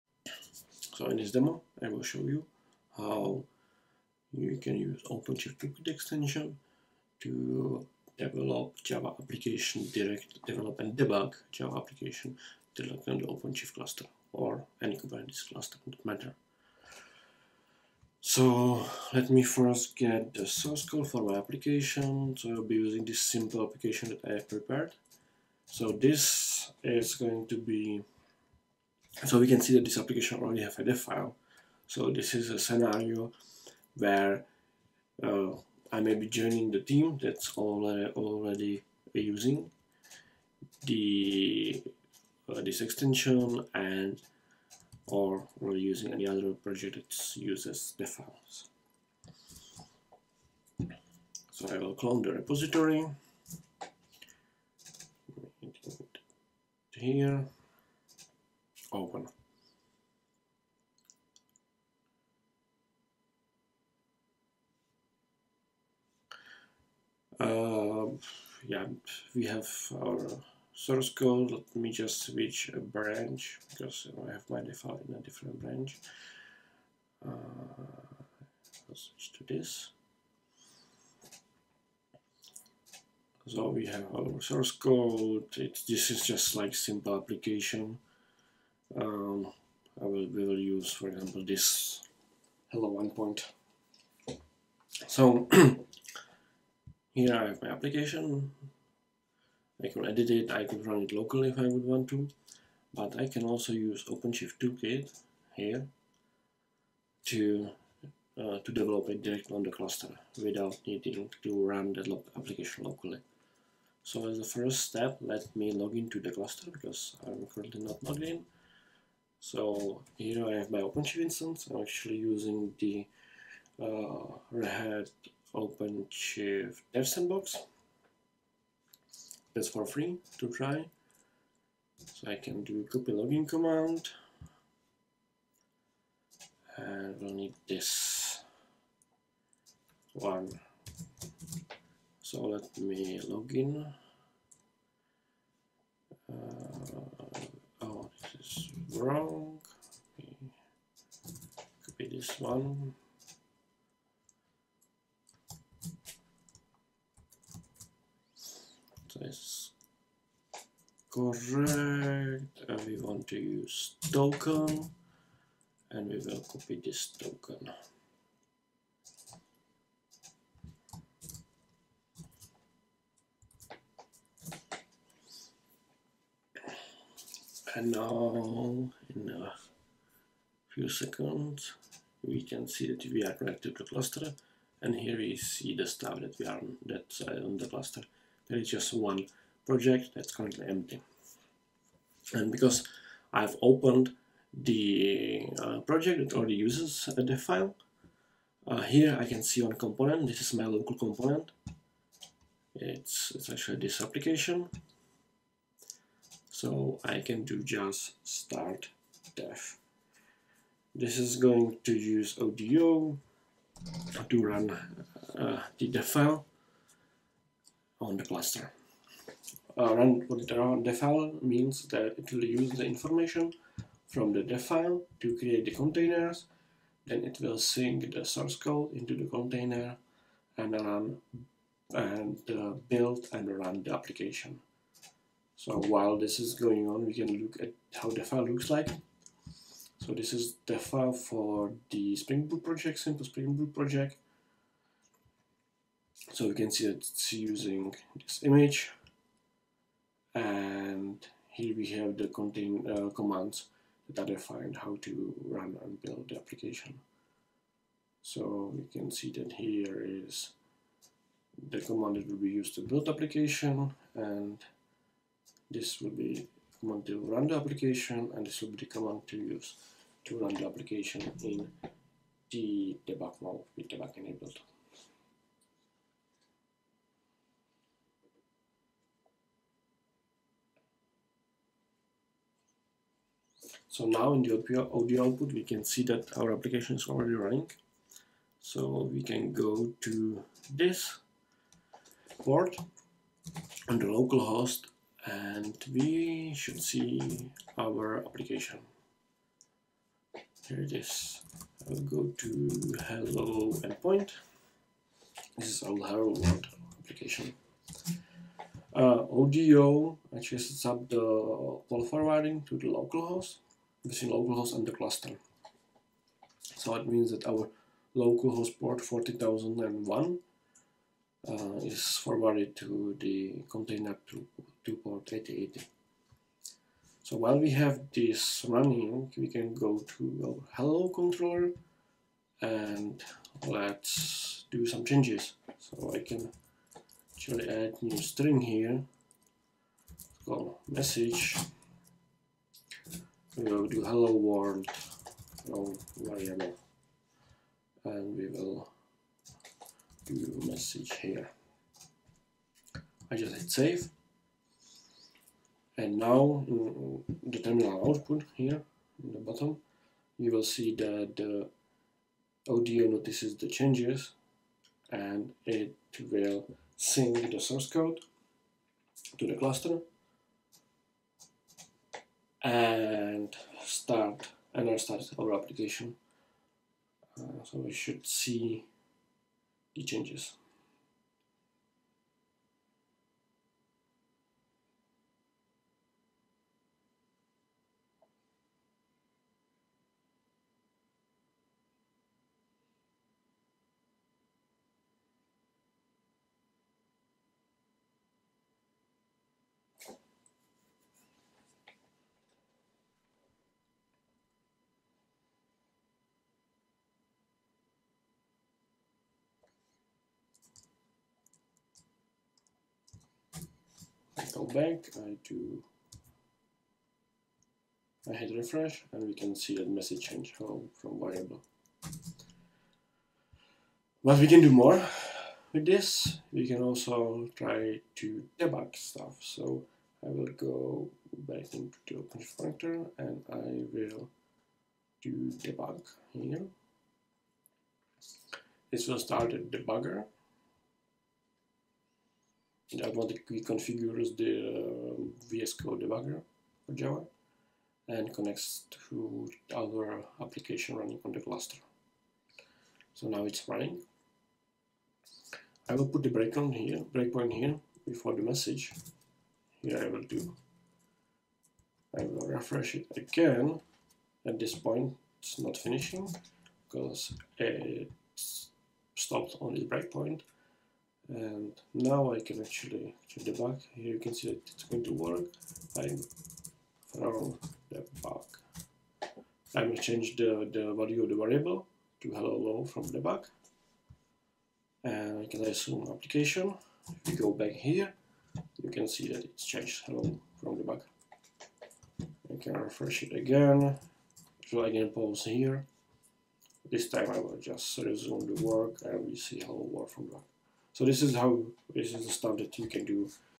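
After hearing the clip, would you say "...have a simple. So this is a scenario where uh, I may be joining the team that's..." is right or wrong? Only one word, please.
wrong.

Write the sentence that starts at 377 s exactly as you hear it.
Uh, so we should see it changes.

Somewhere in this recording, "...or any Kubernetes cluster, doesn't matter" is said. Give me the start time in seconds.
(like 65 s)
14 s.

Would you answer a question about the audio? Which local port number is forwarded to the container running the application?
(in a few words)
40,001.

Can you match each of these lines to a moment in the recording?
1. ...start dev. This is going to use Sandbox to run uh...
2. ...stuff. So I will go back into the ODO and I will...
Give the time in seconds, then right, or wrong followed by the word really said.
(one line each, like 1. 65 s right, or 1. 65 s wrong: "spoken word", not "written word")
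1. 208 s wrong: "ODO", not "Sandbox"
2. 428 s wrong: "OpenShift", not "ODO".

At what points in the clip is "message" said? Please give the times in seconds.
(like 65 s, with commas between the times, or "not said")
340 s, 350 s, 419 s, 458 s.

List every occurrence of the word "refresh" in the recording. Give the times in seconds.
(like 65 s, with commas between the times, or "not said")
418 s, 462 s, 492 s.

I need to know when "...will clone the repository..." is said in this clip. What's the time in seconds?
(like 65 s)
51 s.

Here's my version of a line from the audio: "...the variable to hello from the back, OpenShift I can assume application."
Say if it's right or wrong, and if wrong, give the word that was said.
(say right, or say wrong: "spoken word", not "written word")
wrong: "And", not "OpenShift".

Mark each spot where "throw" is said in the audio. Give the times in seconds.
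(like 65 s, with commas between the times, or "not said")
477 s.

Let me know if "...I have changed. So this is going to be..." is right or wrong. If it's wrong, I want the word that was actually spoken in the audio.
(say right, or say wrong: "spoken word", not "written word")
wrong: "prepared", not "changed".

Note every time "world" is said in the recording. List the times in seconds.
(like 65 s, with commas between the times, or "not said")
306 s, 344 s, 499 s.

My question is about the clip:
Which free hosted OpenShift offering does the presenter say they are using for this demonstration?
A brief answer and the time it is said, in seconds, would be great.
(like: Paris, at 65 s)
Red Hat OpenShift Dev Sandbox, at 124 s.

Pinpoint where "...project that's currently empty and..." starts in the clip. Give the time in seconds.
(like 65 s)
189 s.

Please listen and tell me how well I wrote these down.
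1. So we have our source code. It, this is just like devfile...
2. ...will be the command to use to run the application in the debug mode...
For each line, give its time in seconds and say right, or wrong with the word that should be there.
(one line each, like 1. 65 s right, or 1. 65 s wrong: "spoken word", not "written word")
1. 83 s wrong: "simple", not "devfile"
2. 268 s right.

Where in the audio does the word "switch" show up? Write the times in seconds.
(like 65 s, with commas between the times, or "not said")
72 s, 78 s.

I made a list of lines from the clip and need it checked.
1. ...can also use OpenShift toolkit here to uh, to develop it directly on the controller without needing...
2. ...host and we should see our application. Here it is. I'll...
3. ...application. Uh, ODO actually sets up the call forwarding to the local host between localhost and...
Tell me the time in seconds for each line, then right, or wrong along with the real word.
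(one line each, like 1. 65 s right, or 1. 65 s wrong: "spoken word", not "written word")
1. 103 s wrong: "cluster", not "controller"
2. 294 s right
3. 307 s right.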